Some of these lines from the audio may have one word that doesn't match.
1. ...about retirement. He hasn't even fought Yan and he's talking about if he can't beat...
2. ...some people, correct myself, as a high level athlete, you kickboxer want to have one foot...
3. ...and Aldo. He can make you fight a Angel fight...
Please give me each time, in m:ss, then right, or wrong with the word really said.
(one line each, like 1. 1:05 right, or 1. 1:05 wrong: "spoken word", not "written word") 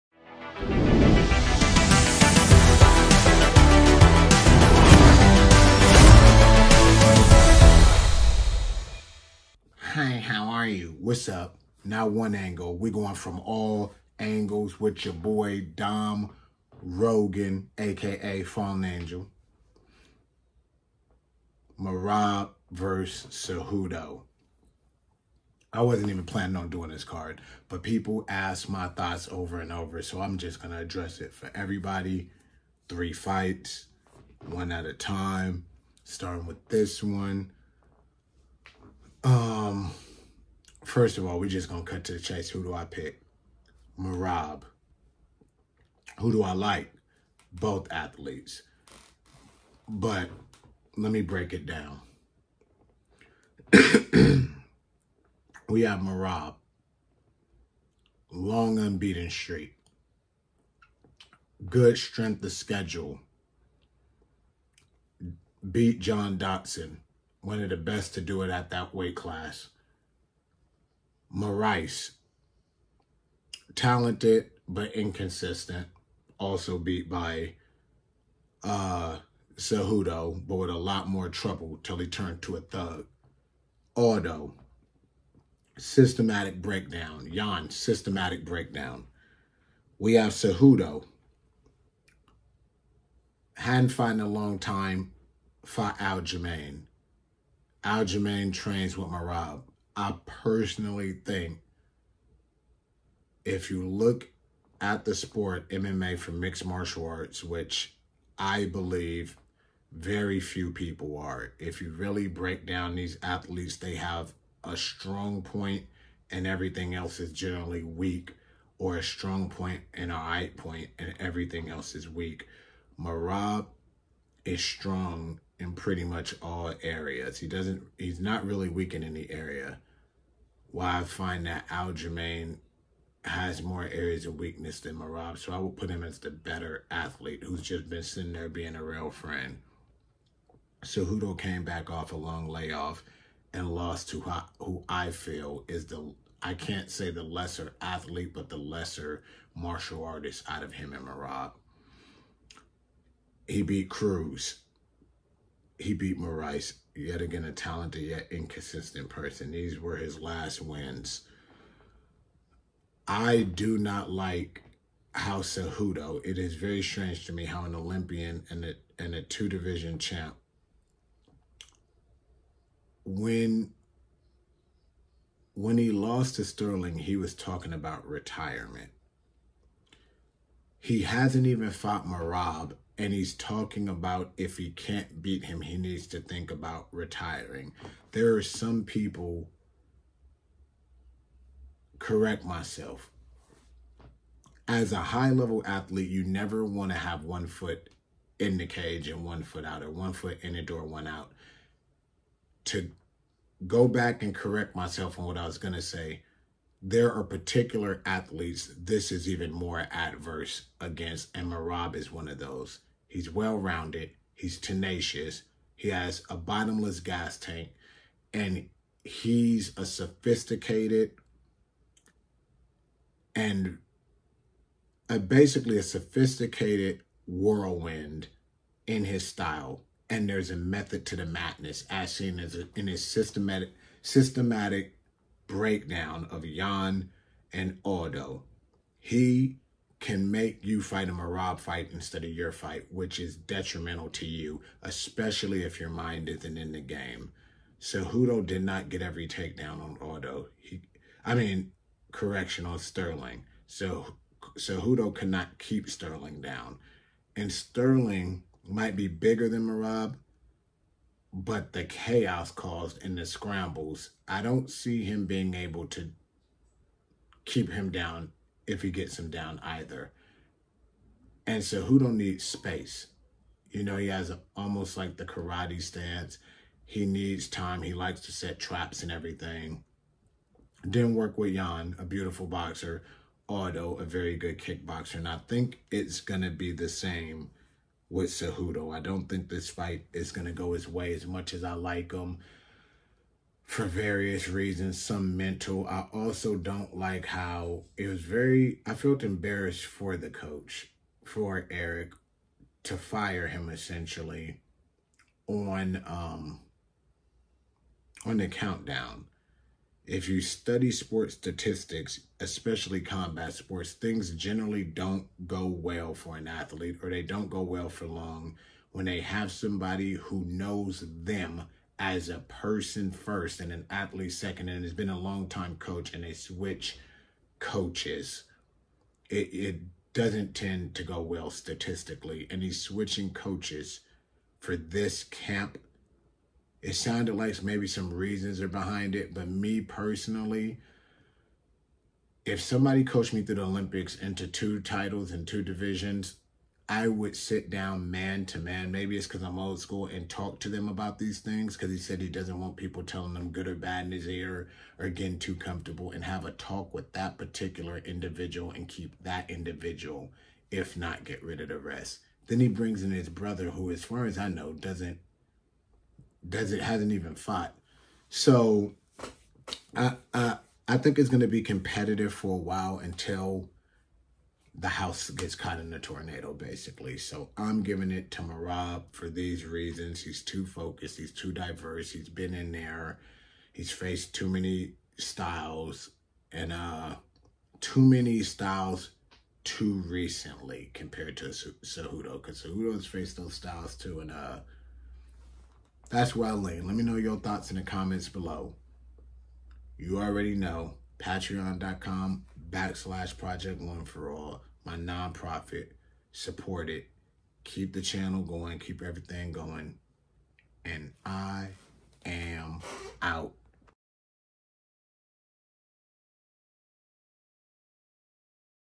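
1. 2:57 wrong: "Merab", not "Yan"
2. 3:08 wrong: "never", not "kickboxer"
3. 3:57 wrong: "Rob", not "Angel".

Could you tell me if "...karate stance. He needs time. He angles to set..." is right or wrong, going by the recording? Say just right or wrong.
wrong.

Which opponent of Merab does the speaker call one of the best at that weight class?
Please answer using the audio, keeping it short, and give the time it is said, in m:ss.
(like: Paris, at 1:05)
John Dotson, at 1:06.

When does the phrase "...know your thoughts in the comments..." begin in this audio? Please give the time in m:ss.
6:37.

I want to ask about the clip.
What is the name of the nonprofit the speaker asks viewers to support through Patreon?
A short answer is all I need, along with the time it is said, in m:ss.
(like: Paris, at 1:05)
Project One For All, at 6:43.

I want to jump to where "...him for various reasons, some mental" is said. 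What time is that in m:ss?
4:52.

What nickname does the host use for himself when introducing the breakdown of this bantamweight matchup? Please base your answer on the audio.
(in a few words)
Fallen Angel.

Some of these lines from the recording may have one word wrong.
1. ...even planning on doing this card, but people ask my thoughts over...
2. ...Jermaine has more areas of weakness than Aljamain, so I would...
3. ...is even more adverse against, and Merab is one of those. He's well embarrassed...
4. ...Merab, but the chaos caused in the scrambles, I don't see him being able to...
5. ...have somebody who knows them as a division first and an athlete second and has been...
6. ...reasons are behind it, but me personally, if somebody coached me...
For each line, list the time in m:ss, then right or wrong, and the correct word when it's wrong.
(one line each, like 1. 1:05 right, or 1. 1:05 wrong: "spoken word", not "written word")
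1. 0:26 right
2. 2:11 wrong: "Merab", not "Aljamain"
3. 3:29 wrong: "rounded", not "embarrassed"
4. 4:19 right
5. 5:19 wrong: "person", not "division"
6. 5:38 right.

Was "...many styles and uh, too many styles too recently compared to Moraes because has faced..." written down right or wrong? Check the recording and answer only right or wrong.
wrong.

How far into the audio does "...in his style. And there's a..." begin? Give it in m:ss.
3:48.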